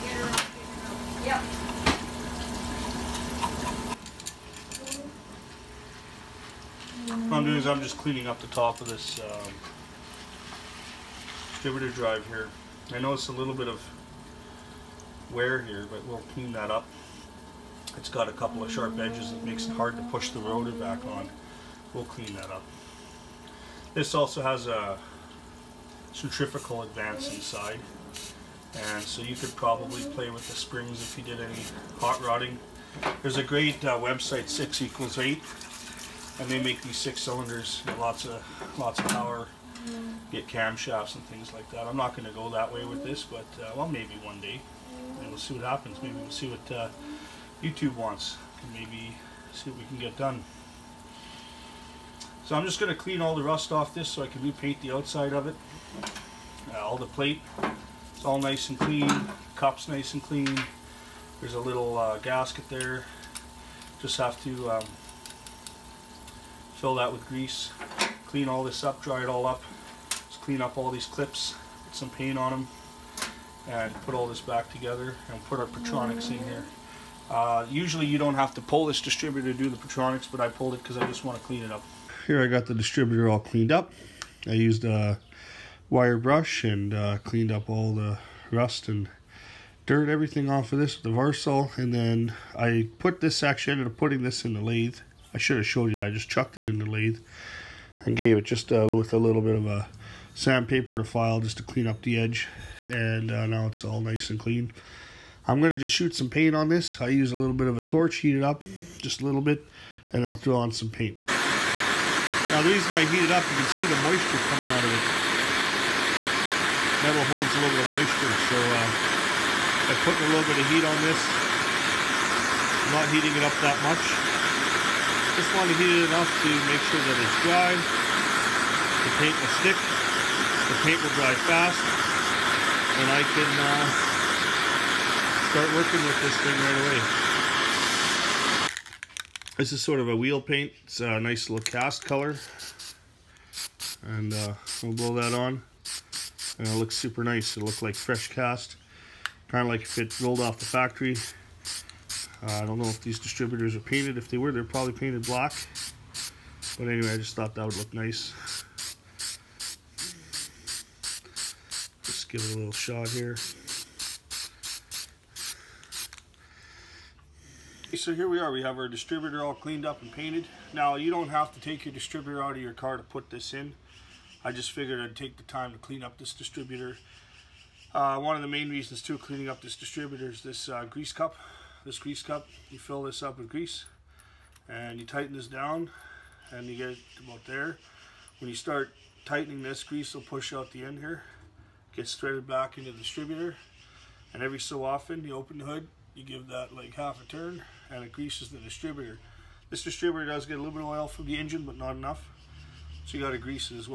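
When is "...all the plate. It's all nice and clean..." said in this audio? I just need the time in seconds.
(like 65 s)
56 s.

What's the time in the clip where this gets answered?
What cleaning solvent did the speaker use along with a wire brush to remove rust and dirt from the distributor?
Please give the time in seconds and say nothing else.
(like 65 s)
91 s.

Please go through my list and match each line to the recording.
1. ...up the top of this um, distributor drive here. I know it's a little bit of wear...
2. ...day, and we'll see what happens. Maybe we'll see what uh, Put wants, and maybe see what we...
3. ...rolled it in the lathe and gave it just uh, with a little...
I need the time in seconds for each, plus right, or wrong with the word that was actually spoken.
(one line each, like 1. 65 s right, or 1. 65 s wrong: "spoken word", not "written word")
1. 8 s right
2. 44 s wrong: "YouTube", not "Put"
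3. 96 s wrong: "chucked", not "rolled".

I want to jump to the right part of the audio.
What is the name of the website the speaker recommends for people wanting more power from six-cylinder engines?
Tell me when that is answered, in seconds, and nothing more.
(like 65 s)
34 s.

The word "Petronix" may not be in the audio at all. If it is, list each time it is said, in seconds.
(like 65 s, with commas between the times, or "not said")
75 s, 79 s.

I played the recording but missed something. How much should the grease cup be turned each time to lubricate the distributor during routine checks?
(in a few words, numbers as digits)
Half a turn.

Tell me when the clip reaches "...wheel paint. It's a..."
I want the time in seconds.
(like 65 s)
140 s.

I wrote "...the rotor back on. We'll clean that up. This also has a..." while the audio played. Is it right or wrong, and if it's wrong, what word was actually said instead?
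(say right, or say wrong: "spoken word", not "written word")
right.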